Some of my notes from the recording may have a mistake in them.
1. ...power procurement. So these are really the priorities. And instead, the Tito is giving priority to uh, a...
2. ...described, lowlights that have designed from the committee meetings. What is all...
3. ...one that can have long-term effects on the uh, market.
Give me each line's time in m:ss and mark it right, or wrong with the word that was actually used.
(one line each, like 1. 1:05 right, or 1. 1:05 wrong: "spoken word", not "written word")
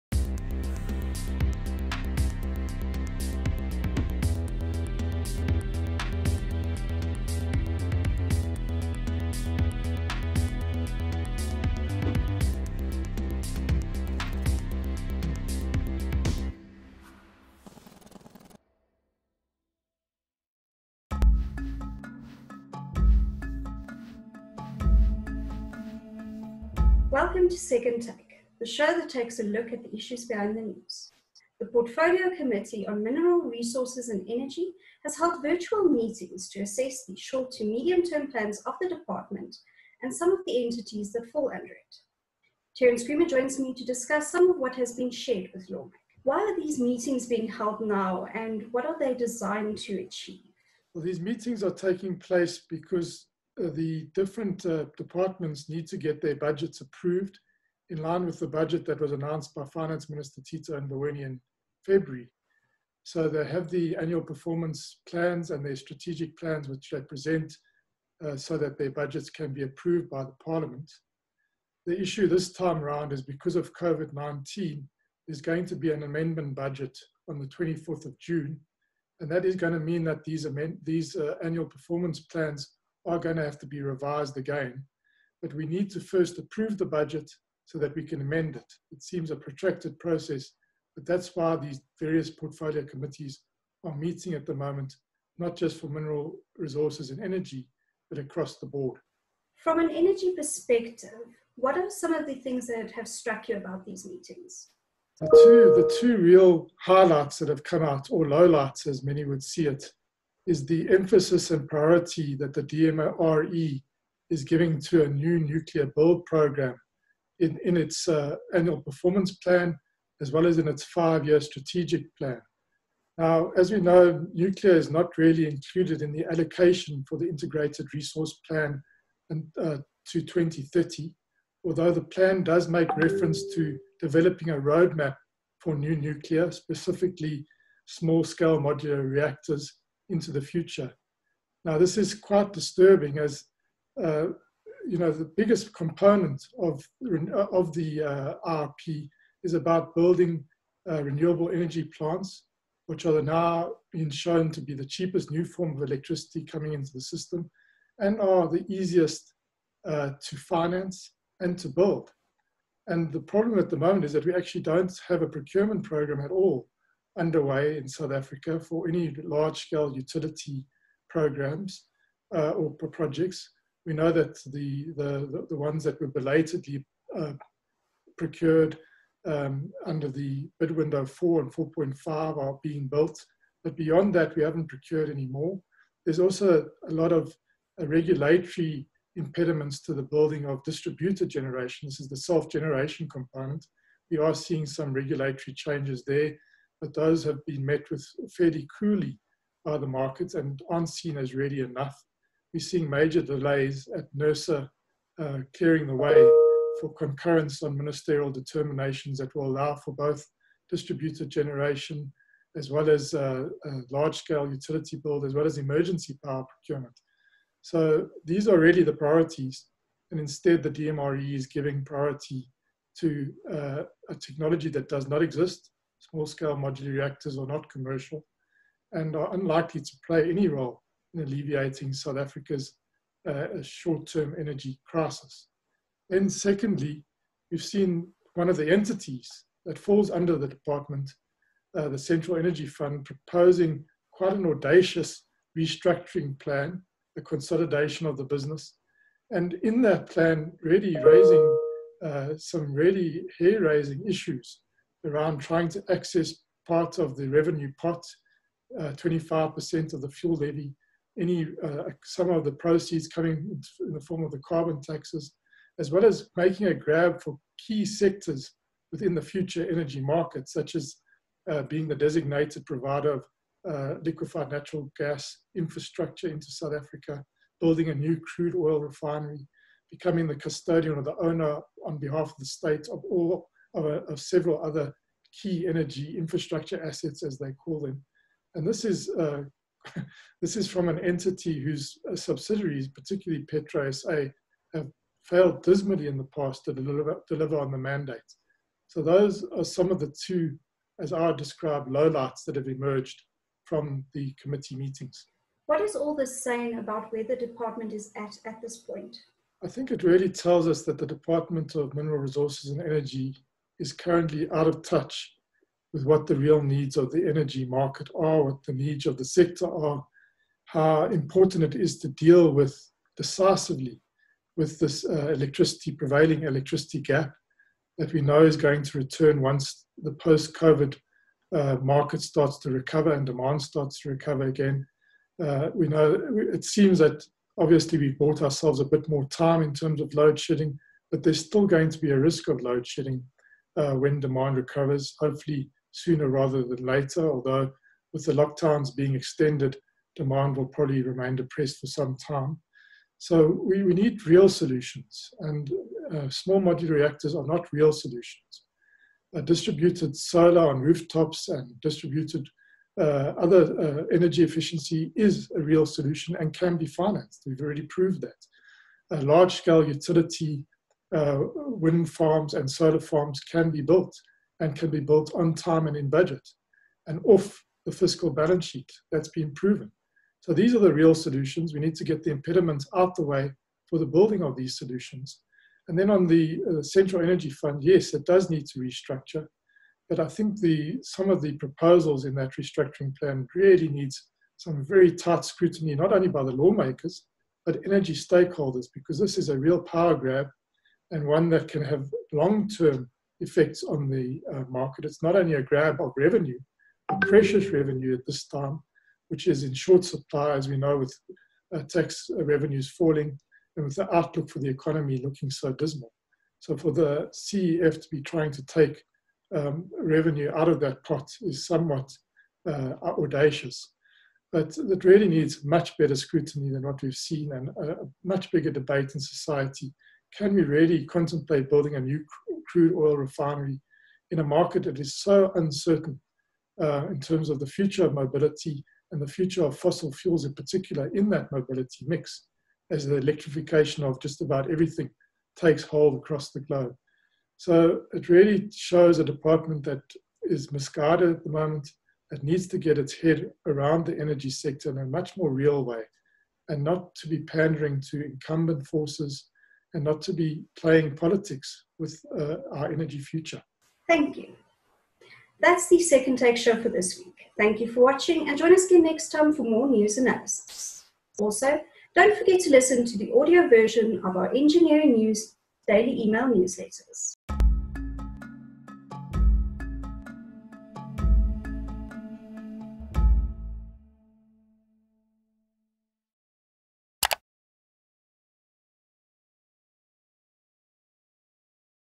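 1. 3:36 wrong: "DMRE", not "Tito"
2. 5:01 wrong: "emerged", not "designed"
3. 6:41 right.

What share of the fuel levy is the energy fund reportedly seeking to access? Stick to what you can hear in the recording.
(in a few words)
25%.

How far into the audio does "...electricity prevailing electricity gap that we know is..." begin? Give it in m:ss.
5:25.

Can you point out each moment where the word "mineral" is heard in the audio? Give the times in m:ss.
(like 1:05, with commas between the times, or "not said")
0:33, 1:35, 5:11.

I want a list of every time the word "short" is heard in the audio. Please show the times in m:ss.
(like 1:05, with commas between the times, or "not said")
0:37, 3:53, 6:49.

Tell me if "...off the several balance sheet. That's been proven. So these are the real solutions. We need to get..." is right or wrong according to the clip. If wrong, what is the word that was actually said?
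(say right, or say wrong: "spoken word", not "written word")
wrong: "fiscal", not "several".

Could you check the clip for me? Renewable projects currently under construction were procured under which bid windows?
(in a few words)
4 and 4.5.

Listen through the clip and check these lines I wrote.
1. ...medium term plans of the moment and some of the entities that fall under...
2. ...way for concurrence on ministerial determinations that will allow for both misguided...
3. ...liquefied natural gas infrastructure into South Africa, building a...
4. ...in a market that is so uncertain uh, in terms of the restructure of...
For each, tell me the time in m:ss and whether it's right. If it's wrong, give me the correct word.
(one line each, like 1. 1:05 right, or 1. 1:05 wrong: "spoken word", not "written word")
1. 0:37 wrong: "department", not "moment"
2. 3:25 wrong: "distributed", not "misguided"
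3. 4:34 right
4. 7:14 wrong: "future", not "restructure".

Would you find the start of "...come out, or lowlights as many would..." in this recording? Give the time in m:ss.
1:47.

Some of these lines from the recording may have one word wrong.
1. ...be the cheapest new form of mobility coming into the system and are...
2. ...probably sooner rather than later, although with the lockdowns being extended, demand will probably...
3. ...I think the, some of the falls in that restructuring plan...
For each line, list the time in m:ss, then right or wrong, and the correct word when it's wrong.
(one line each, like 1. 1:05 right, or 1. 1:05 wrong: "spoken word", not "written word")
1. 2:34 wrong: "electricity", not "mobility"
2. 5:45 wrong: "hopefully", not "probably"
3. 6:30 wrong: "proposals", not "falls".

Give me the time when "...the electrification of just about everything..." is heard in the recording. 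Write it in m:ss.
7:23.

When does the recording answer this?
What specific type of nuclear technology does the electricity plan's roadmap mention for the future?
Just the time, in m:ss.
2:17.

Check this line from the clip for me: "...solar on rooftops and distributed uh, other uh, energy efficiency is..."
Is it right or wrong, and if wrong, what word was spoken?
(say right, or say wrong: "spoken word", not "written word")
right.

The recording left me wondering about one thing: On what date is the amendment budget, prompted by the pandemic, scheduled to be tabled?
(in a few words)
24th of June.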